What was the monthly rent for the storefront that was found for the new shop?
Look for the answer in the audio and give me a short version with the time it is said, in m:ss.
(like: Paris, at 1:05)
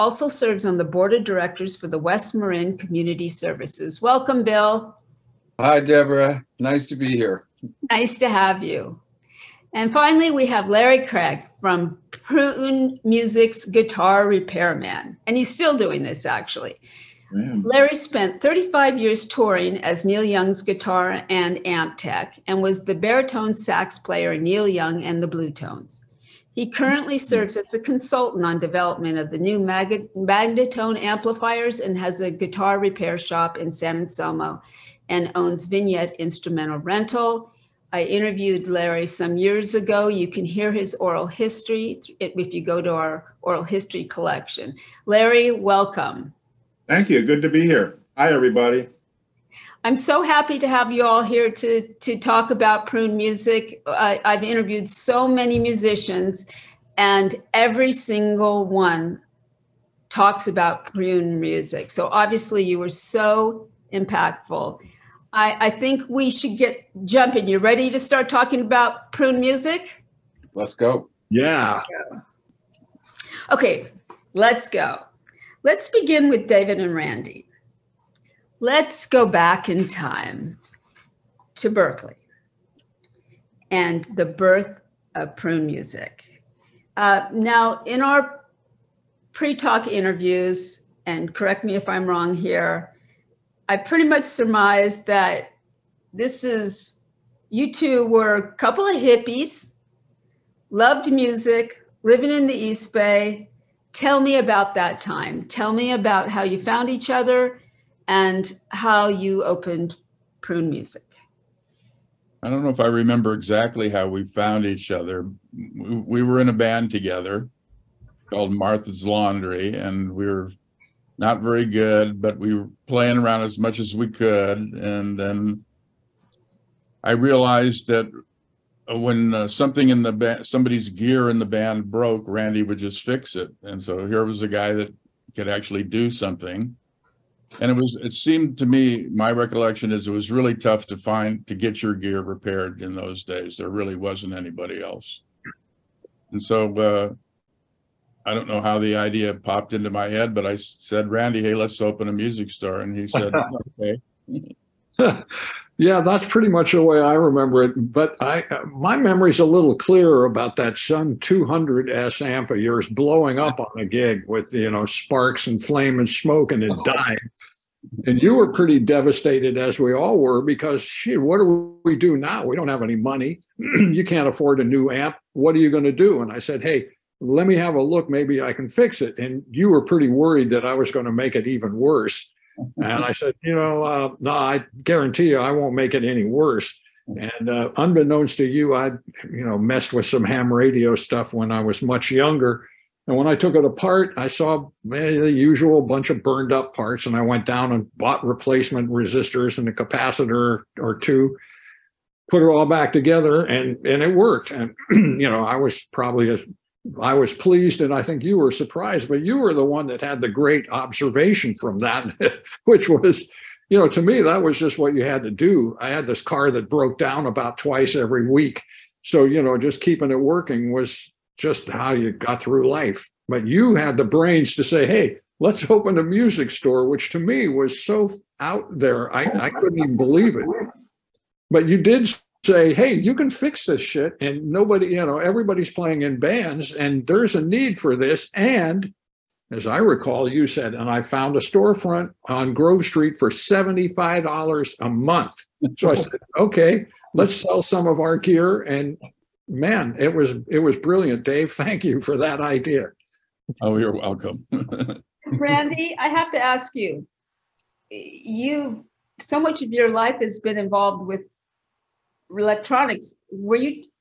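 $75, at 4:03.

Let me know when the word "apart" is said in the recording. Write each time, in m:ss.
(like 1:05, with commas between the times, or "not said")
3:13.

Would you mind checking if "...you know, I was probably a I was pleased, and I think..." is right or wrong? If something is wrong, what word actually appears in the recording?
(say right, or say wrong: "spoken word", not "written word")
right.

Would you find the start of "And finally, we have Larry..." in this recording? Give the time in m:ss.
0:09.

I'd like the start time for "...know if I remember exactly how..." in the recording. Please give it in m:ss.
1:52.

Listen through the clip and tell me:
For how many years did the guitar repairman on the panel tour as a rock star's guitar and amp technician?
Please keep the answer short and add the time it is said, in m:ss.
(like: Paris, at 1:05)
35, at 0:18.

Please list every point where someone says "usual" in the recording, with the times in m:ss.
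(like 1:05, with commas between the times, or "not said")
3:15.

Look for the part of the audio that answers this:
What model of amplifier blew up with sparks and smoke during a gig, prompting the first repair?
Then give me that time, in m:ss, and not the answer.
2:40.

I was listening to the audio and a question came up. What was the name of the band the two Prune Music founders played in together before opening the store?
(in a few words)
Martha's Laundry.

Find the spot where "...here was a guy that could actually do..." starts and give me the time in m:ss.
2:14.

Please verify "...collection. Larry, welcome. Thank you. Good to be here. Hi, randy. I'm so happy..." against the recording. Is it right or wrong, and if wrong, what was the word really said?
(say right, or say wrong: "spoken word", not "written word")
wrong: "everybody", not "randy".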